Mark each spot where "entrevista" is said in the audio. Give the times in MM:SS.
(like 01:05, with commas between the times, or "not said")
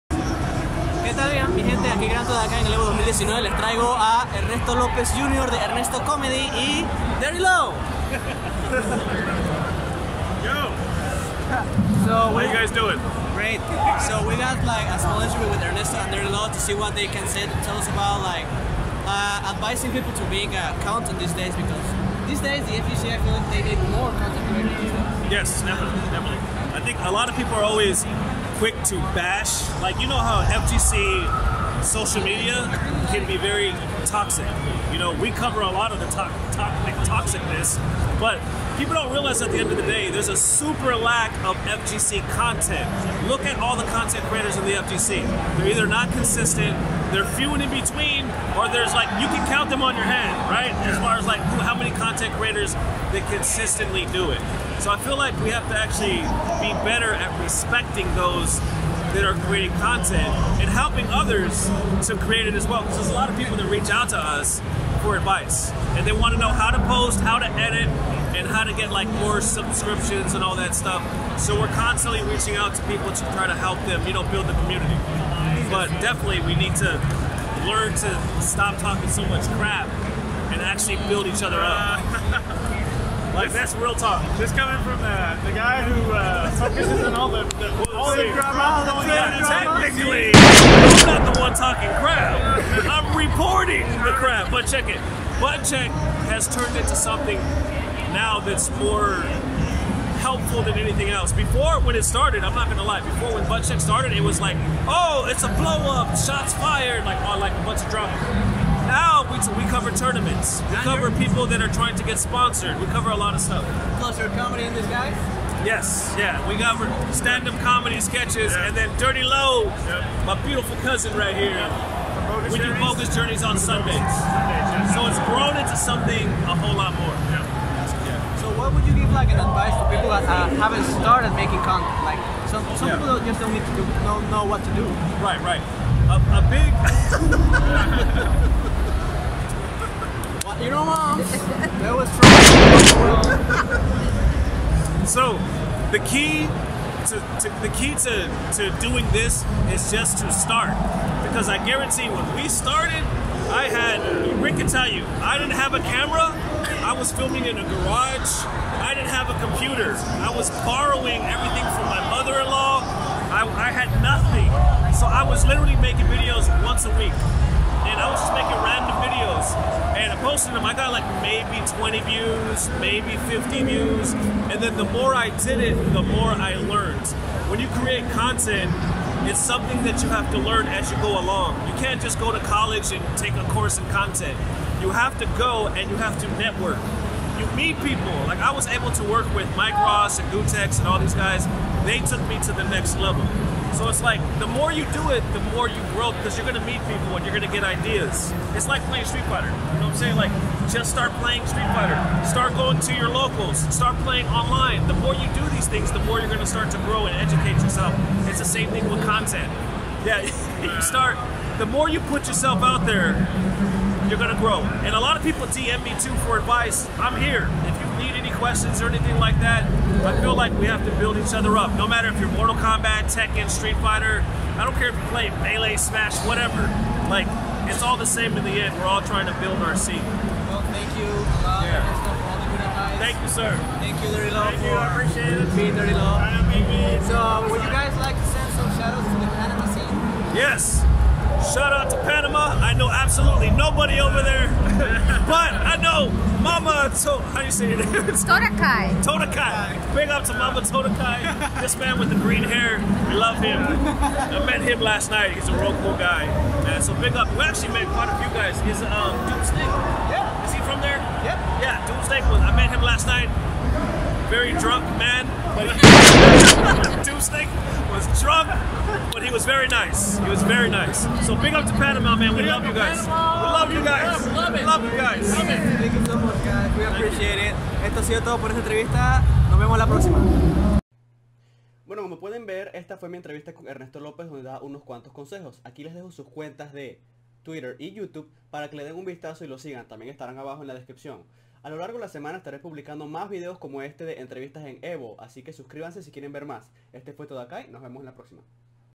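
04:38, 04:43, 04:54.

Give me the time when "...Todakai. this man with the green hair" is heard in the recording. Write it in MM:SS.
04:10.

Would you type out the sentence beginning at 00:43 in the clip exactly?
Look at all the content creators in the FGC.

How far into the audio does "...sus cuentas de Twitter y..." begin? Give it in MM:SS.
04:46.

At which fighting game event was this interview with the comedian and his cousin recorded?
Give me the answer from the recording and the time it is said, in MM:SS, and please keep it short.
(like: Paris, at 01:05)
Evo 2019, at 00:02.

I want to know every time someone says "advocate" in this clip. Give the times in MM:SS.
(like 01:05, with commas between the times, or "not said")
not said.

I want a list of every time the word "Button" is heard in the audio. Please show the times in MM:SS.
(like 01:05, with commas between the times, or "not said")
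01:35, 01:43.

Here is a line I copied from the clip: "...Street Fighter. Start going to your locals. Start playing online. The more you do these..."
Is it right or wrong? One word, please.
right.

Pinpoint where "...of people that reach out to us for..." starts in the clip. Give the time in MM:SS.
01:03.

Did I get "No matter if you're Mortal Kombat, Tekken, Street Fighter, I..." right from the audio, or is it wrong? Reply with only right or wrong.
right.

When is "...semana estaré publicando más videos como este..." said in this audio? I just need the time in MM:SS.
04:52.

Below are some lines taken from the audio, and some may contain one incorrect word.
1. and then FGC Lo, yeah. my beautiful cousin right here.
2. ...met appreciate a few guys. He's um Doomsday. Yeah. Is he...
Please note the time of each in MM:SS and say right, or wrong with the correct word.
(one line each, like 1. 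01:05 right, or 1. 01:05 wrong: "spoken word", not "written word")
1. 01:58 wrong: "Dirty", not "FGC"
2. 04:17 wrong: "quite", not "appreciate".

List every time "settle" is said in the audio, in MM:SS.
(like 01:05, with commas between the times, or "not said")
not said.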